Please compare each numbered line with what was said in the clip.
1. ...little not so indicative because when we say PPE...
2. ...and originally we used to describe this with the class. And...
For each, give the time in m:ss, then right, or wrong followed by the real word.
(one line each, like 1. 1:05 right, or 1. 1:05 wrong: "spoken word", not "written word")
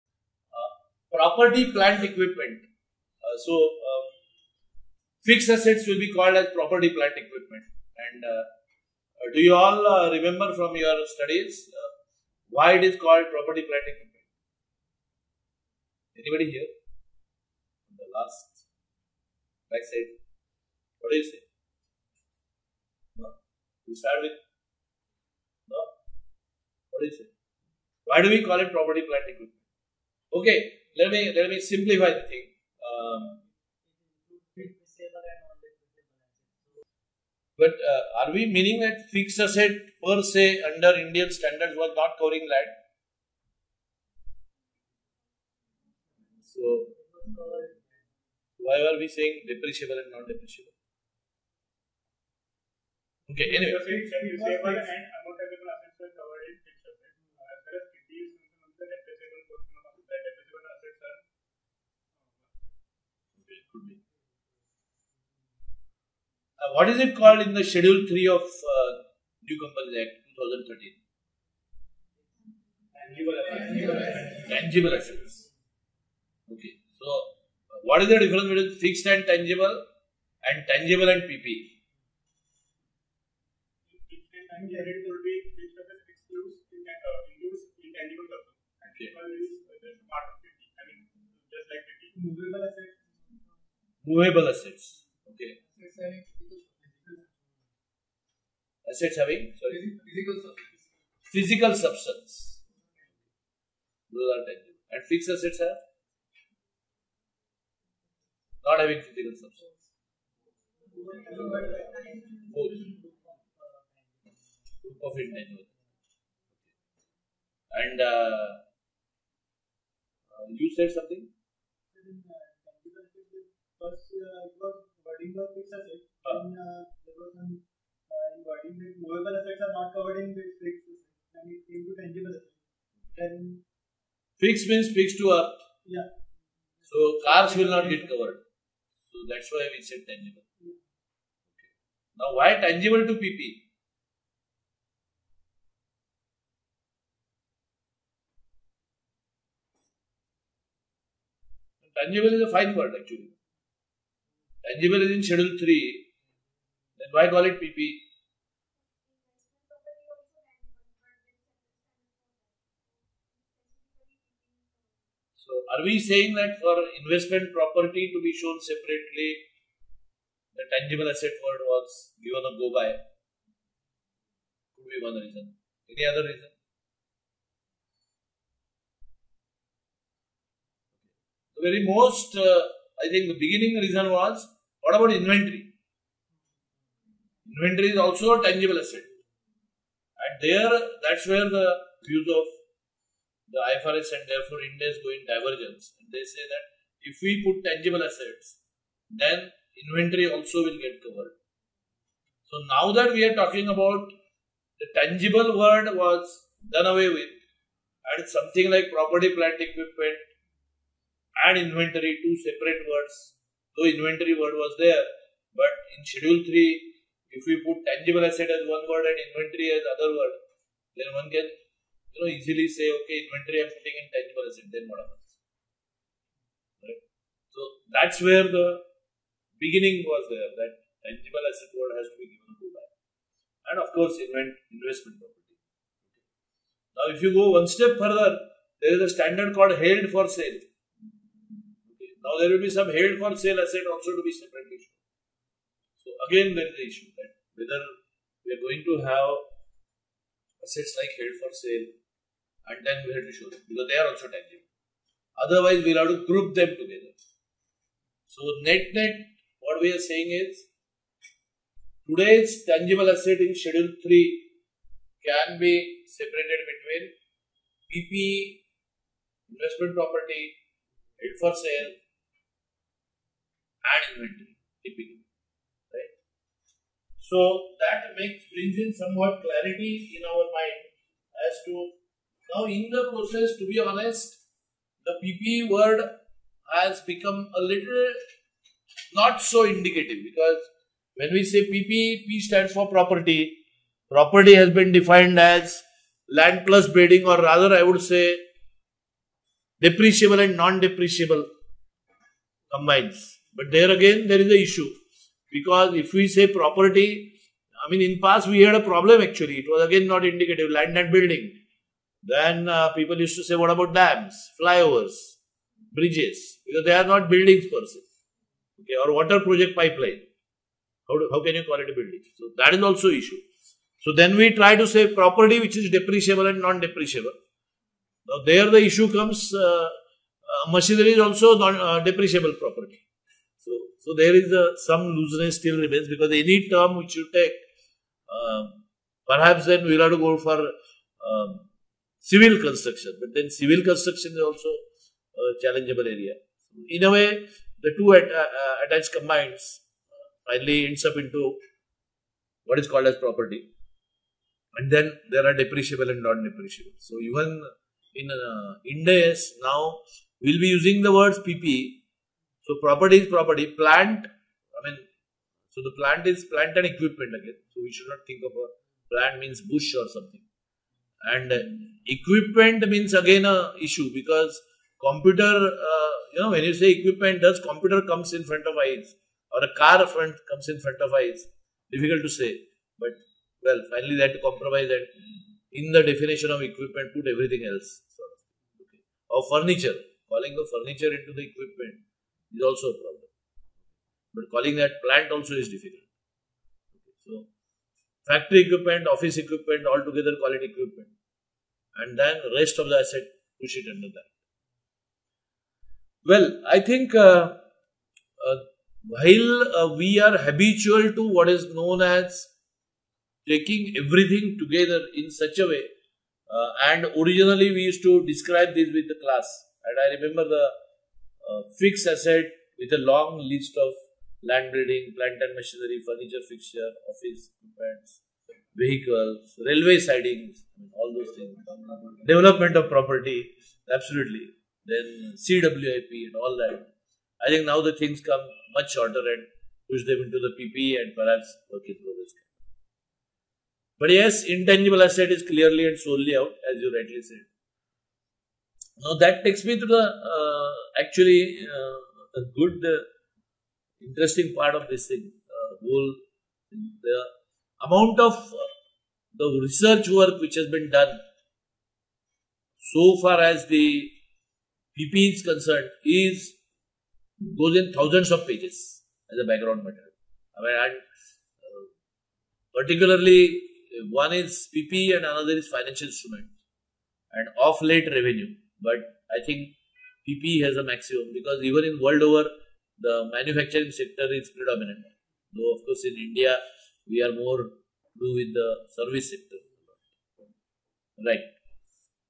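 1. 4:47 right
2. 6:56 right.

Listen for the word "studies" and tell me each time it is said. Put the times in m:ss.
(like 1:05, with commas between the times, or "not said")
0:11.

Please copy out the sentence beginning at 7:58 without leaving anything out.
But I think PPE has a maximum because even in world over, the manufacturing sector is predominant.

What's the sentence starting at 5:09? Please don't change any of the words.
It was again not indicative land and building.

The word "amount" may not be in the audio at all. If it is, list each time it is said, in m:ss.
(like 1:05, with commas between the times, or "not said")
7:37.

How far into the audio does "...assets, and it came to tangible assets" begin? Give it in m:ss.
2:10.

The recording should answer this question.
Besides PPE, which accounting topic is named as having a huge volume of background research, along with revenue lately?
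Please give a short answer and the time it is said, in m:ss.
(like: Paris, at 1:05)
Financial instrument, at 7:55.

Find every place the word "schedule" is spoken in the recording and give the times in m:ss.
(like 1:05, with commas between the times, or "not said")
1:07, 2:35, 3:36, 4:23.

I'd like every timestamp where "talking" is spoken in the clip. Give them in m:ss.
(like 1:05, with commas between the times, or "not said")
3:23.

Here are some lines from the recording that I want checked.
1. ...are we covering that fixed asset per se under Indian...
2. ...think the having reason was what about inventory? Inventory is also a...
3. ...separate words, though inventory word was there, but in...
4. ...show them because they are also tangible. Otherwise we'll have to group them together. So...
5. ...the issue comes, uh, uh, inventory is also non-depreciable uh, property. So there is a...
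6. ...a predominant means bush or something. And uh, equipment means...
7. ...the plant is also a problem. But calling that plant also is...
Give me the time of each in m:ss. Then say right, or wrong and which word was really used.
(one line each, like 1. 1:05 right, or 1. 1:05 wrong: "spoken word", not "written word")
1. 0:38 wrong: "meaning", not "covering"
2. 3:03 wrong: "beginning", not "having"
3. 3:32 right
4. 4:13 right
5. 5:28 wrong: "machinery", not "inventory"
6. 6:08 wrong: "plant", not "predominant"
7. 6:31 wrong: "equipment", not "plant".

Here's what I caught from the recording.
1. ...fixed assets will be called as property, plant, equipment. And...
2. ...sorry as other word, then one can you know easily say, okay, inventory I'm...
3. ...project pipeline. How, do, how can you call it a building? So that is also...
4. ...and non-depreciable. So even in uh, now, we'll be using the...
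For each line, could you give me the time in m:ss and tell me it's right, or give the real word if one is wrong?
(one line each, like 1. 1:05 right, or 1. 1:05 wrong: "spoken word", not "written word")
1. 0:05 right
2. 3:39 wrong: "inventory", not "sorry"
3. 5:19 right
4. 5:56 right.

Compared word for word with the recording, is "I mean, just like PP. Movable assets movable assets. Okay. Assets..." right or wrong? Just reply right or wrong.
right.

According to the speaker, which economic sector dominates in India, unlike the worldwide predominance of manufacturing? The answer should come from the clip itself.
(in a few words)
Service sector.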